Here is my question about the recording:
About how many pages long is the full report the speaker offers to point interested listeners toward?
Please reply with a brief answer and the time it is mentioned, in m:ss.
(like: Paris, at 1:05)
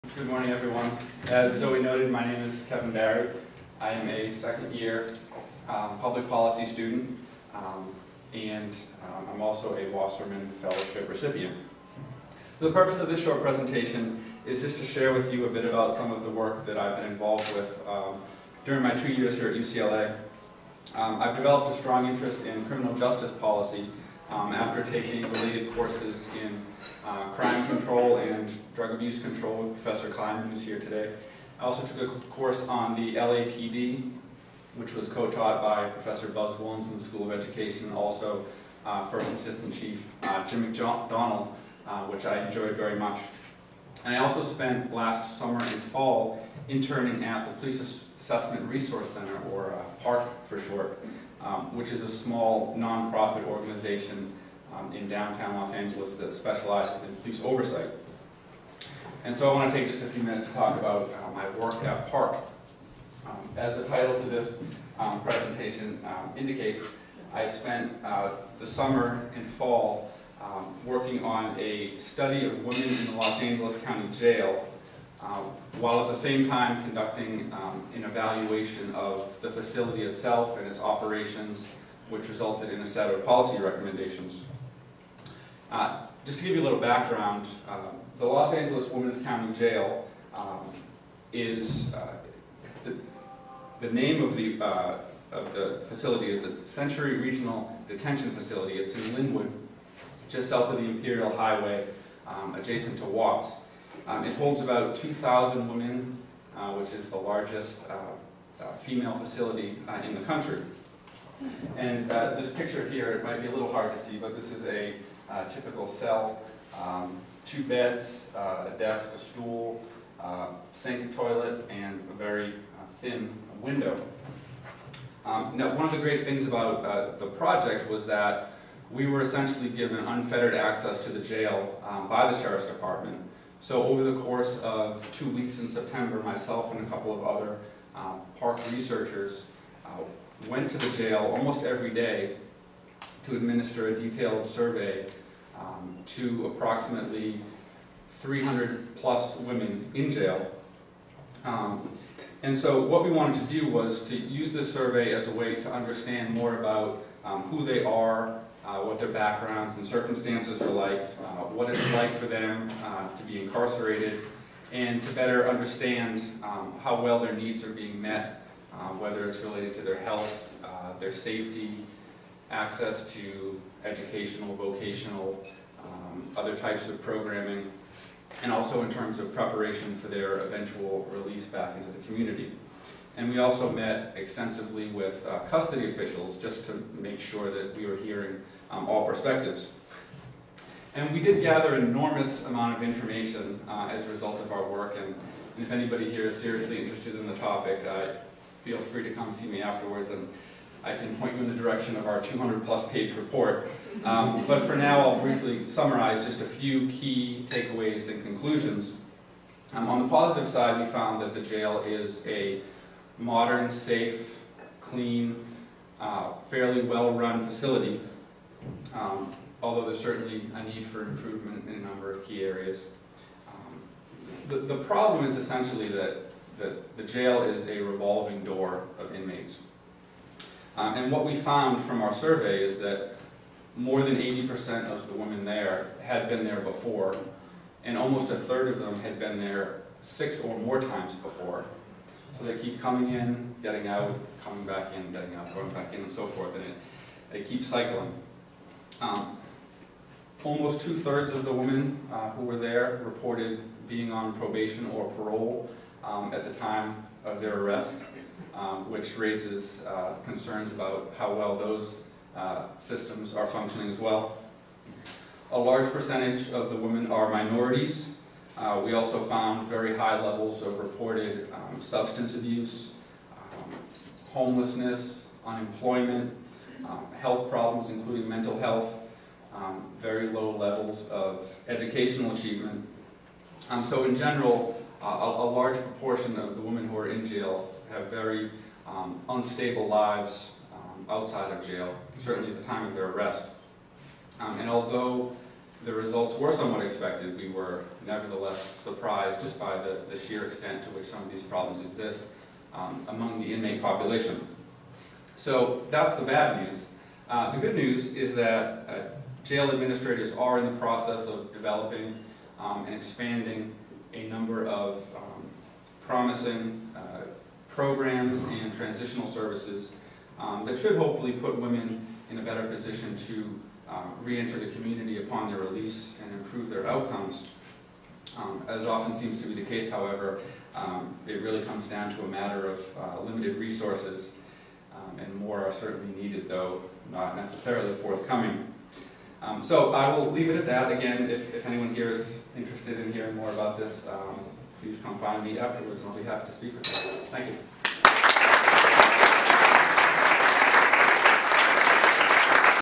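200-plus, at 3:22.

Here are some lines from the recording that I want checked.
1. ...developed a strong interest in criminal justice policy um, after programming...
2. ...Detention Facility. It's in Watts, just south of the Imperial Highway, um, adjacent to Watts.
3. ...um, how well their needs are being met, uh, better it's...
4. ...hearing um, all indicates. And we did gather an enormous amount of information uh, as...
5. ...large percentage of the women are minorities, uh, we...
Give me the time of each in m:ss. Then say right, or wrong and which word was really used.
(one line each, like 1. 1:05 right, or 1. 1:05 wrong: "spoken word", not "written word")
1. 0:21 wrong: "taking", not "programming"
2. 1:37 wrong: "Lynwood", not "Watts"
3. 2:46 wrong: "whether", not "better"
4. 3:07 wrong: "perspectives", not "indicates"
5. 4:25 right.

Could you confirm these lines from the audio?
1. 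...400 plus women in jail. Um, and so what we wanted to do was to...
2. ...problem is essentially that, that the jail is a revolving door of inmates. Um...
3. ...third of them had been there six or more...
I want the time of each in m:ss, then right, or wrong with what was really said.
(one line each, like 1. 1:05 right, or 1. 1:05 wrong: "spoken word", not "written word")
1. 2:28 wrong: "300", not "400"
2. 3:44 right
3. 3:58 right.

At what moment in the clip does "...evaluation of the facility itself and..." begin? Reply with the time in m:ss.
1:18.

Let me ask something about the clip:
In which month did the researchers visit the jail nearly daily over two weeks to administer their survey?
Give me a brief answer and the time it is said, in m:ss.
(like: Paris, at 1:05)
September, at 2:15.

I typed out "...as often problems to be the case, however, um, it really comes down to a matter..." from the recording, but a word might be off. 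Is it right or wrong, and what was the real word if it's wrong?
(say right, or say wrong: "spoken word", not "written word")
wrong: "seems", not "problems".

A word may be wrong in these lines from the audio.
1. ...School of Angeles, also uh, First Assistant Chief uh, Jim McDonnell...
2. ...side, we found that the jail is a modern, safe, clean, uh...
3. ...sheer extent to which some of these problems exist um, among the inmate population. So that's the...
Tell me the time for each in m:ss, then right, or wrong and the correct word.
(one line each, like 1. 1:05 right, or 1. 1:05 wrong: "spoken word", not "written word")
1. 0:37 wrong: "Education", not "Angeles"
2. 3:30 right
3. 5:00 right.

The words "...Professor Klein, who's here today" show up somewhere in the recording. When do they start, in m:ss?
0:29.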